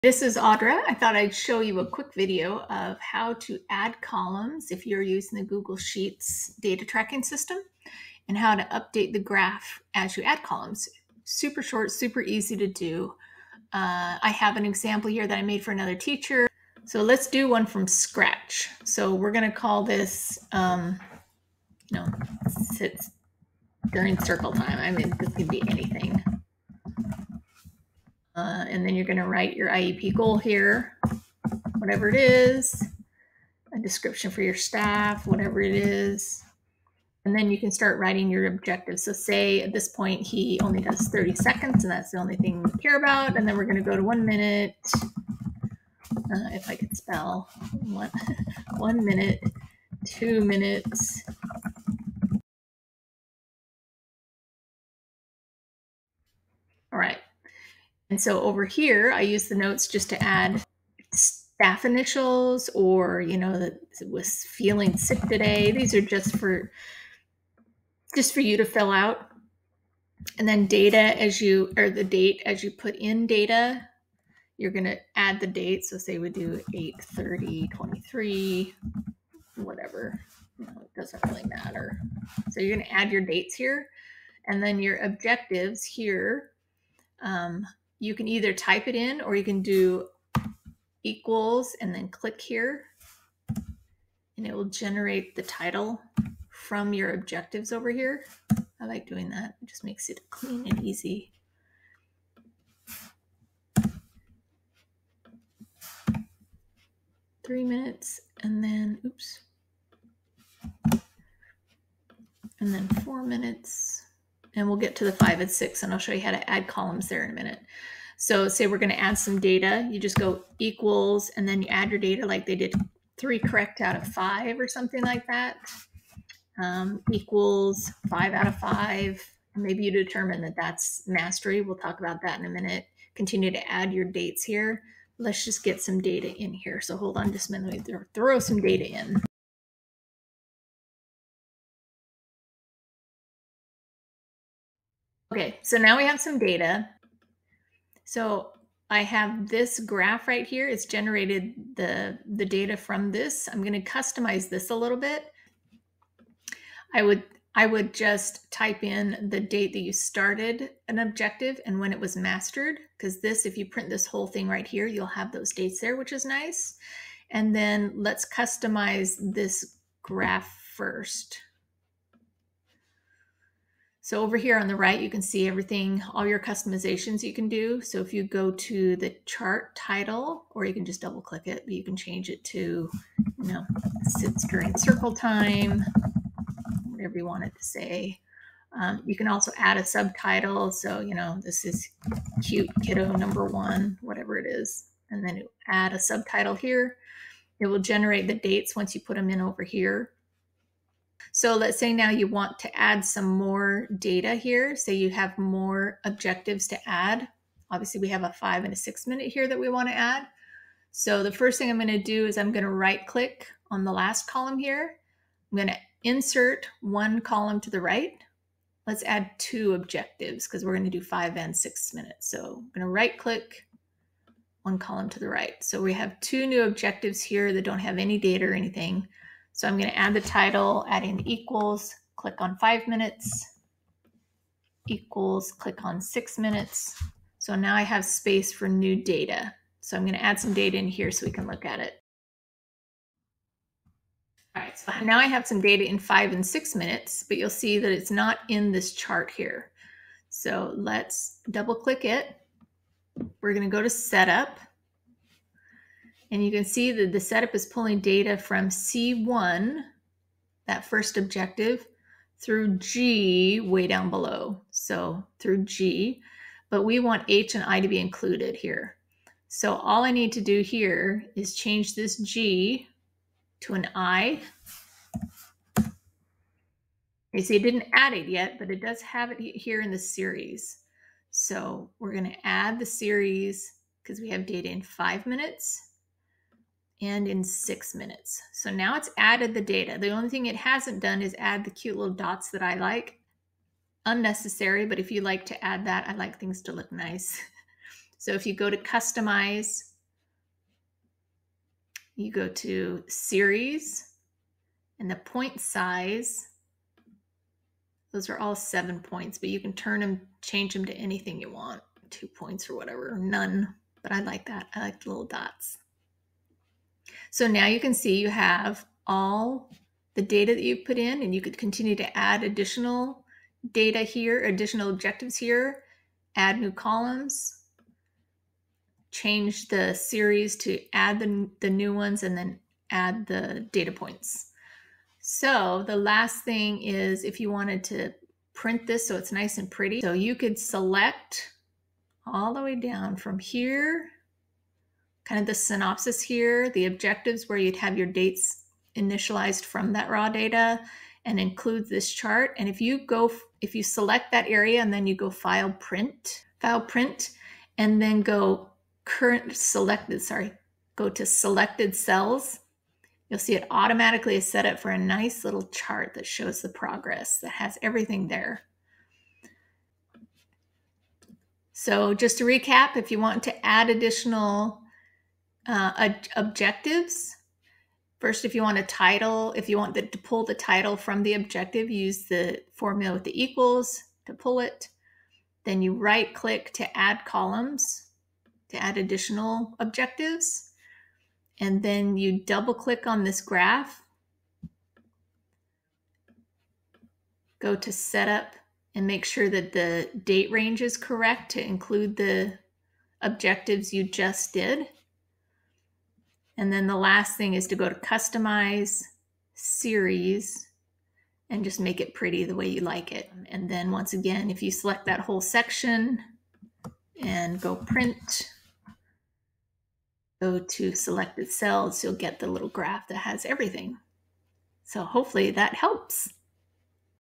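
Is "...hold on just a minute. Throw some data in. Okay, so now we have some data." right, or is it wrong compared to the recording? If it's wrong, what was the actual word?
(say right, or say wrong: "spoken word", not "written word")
right.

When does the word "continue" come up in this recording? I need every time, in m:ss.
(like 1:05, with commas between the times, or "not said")
2:13, 5:21.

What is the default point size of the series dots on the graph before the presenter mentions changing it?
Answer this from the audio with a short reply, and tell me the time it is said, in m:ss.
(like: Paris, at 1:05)
7 points, at 5:08.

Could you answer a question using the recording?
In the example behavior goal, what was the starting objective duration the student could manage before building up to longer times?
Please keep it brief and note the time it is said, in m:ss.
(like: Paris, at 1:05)
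30 seconds, at 0:41.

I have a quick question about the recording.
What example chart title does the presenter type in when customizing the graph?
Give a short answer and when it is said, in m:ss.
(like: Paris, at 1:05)
sits during circle time, at 3:04.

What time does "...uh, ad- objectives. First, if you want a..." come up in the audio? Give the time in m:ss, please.
6:15.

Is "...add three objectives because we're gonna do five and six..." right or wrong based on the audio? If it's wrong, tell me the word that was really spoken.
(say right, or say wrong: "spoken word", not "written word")
wrong: "two", not "three".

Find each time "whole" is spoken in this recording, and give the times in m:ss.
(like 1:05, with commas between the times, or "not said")
2:44, 6:55.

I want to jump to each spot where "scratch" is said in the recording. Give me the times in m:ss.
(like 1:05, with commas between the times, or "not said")
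0:17.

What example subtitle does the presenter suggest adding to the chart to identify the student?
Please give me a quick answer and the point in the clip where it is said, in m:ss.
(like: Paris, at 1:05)
cute kiddo number one, at 3:12.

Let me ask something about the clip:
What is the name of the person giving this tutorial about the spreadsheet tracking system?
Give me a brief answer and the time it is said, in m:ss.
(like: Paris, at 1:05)
Audra, at 0:00.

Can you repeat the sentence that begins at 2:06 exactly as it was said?
Um, equals five out of five.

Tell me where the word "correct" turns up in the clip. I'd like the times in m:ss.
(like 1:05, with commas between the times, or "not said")
2:03, 6:40.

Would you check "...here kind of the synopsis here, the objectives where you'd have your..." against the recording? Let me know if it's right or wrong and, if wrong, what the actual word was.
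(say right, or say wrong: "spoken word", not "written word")
right.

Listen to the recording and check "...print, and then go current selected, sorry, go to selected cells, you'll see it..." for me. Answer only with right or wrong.
right.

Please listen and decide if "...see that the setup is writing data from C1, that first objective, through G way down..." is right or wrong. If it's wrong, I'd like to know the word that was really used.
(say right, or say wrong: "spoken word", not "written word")
wrong: "pulling", not "writing".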